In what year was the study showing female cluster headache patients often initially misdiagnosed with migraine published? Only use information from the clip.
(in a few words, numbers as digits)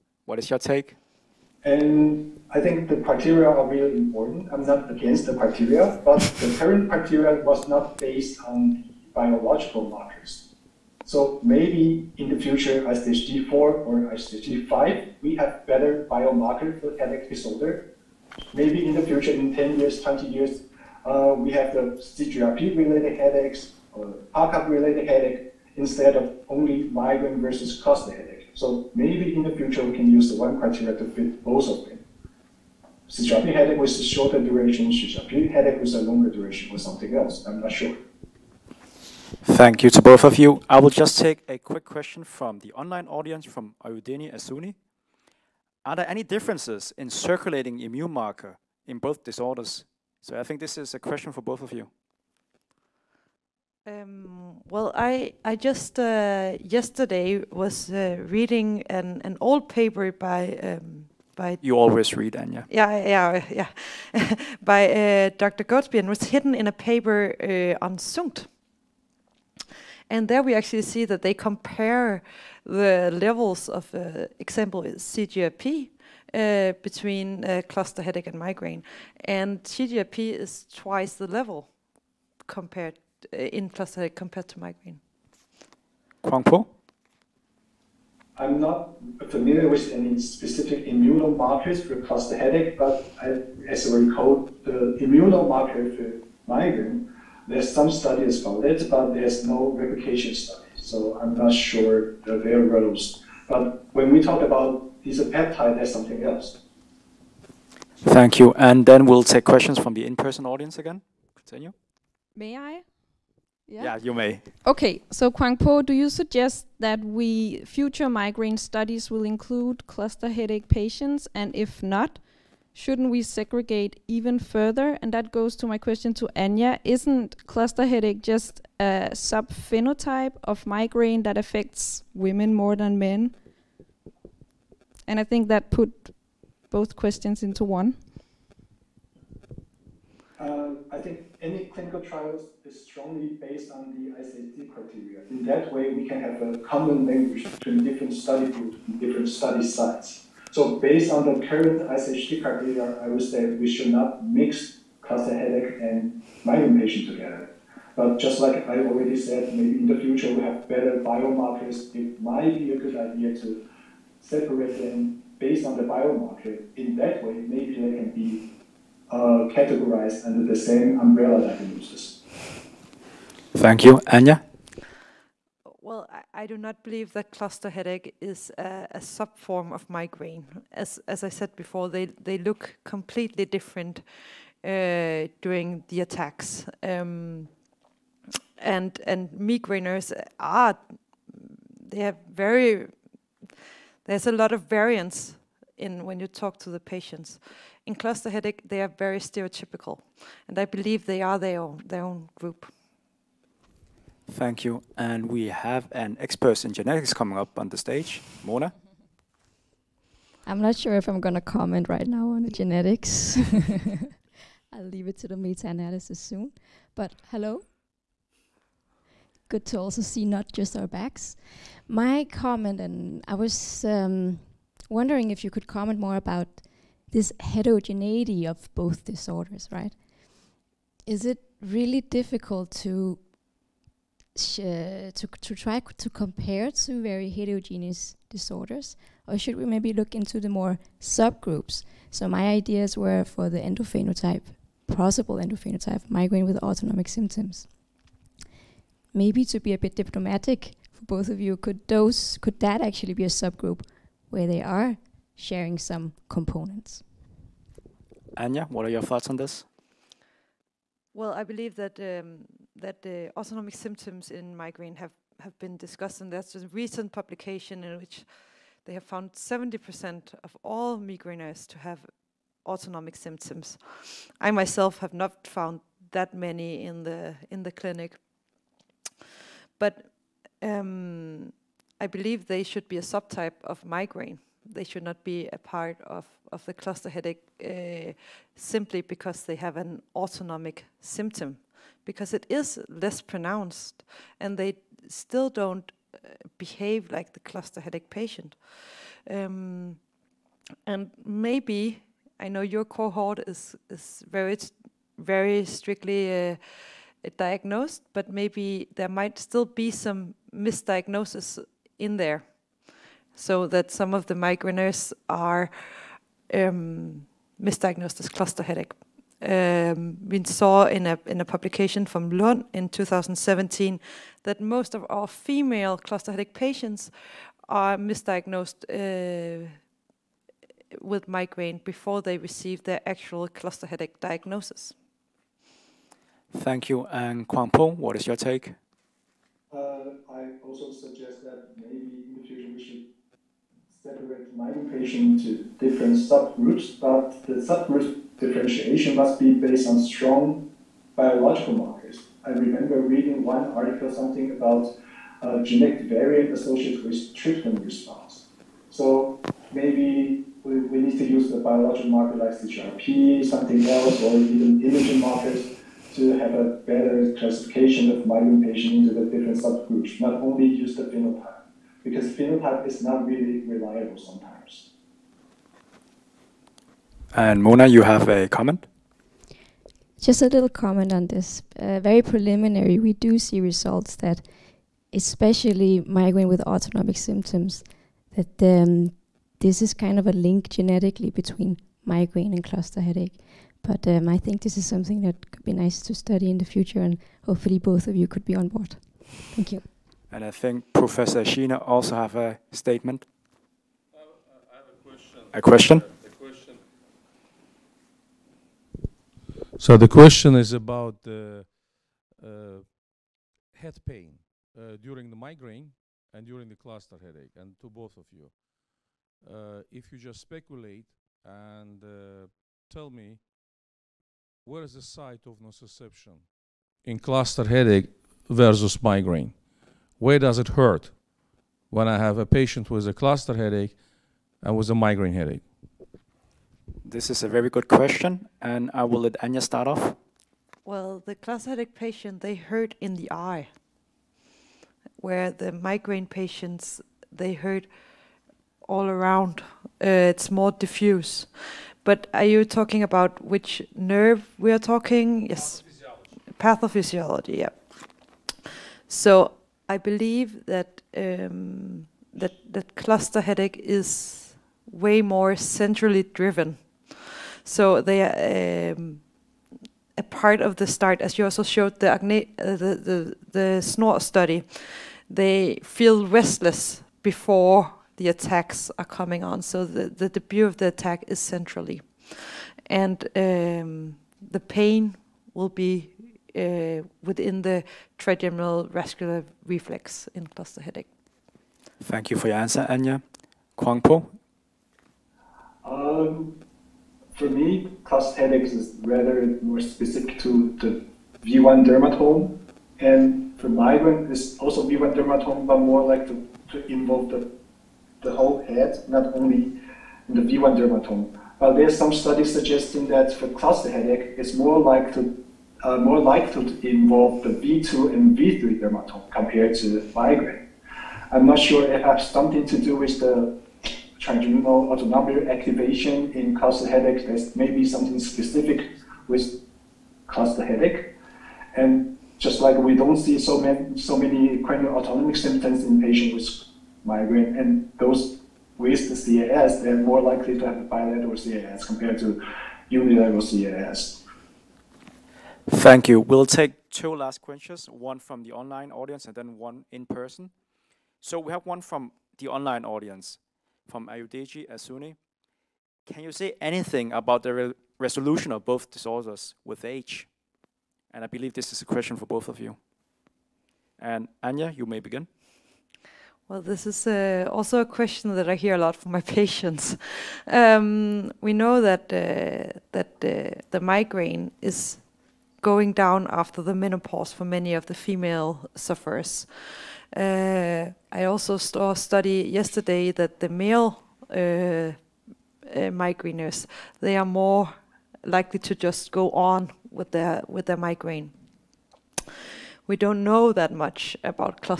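2017.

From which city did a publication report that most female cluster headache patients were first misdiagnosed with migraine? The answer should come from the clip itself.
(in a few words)
Lund.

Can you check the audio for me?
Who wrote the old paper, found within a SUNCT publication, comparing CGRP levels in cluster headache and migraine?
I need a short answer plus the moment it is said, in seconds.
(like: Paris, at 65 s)
Dr. Goadsby, at 65 s.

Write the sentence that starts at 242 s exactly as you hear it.
So my ideas were for the endophenotype, possible endophenotype, migraine with autonomic symptoms.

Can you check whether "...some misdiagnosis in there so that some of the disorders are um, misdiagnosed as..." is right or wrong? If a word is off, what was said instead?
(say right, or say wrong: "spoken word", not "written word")
wrong: "migraineurs", not "disorders".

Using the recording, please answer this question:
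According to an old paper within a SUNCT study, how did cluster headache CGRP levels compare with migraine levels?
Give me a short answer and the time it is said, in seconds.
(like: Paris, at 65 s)
twice the level, at 80 s.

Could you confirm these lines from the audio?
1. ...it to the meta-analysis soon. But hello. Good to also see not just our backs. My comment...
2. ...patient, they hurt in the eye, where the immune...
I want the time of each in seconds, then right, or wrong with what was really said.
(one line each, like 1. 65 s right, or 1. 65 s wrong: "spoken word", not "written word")
1. 215 s right
2. 441 s wrong: "migraine", not "immune".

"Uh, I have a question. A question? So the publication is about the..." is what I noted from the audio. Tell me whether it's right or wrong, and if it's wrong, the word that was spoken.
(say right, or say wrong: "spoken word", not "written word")
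wrong: "question", not "publication".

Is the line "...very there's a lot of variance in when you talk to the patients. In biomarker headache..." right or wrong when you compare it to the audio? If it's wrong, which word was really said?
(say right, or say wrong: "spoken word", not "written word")
wrong: "cluster", not "biomarker".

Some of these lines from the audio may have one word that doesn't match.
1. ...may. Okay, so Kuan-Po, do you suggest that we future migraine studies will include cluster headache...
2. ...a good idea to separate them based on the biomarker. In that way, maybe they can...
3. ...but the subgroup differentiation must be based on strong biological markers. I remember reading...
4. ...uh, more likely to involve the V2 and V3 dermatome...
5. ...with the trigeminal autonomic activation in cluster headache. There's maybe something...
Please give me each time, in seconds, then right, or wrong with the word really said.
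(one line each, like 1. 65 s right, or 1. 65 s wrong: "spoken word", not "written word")
1. 114 s right
2. 162 s right
3. 346 s right
4. 515 s right
5. 522 s right.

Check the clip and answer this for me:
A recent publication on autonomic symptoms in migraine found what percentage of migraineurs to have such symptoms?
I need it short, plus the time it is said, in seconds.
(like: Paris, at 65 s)
70%, at 269 s.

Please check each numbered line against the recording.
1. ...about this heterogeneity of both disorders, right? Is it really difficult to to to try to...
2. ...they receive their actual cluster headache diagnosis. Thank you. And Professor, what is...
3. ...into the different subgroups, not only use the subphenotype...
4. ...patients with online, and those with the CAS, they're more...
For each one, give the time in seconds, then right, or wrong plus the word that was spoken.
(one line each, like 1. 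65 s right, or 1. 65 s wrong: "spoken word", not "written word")
1. 226 s right
2. 332 s wrong: "Kwangpong", not "Professor"
3. 368 s wrong: "phenotype", not "subphenotype"
4. 536 s wrong: "migraine", not "online".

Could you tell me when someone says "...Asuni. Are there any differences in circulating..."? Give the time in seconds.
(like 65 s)
44 s.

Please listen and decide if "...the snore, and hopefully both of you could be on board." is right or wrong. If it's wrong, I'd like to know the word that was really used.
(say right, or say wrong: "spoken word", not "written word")
wrong: "future", not "snore".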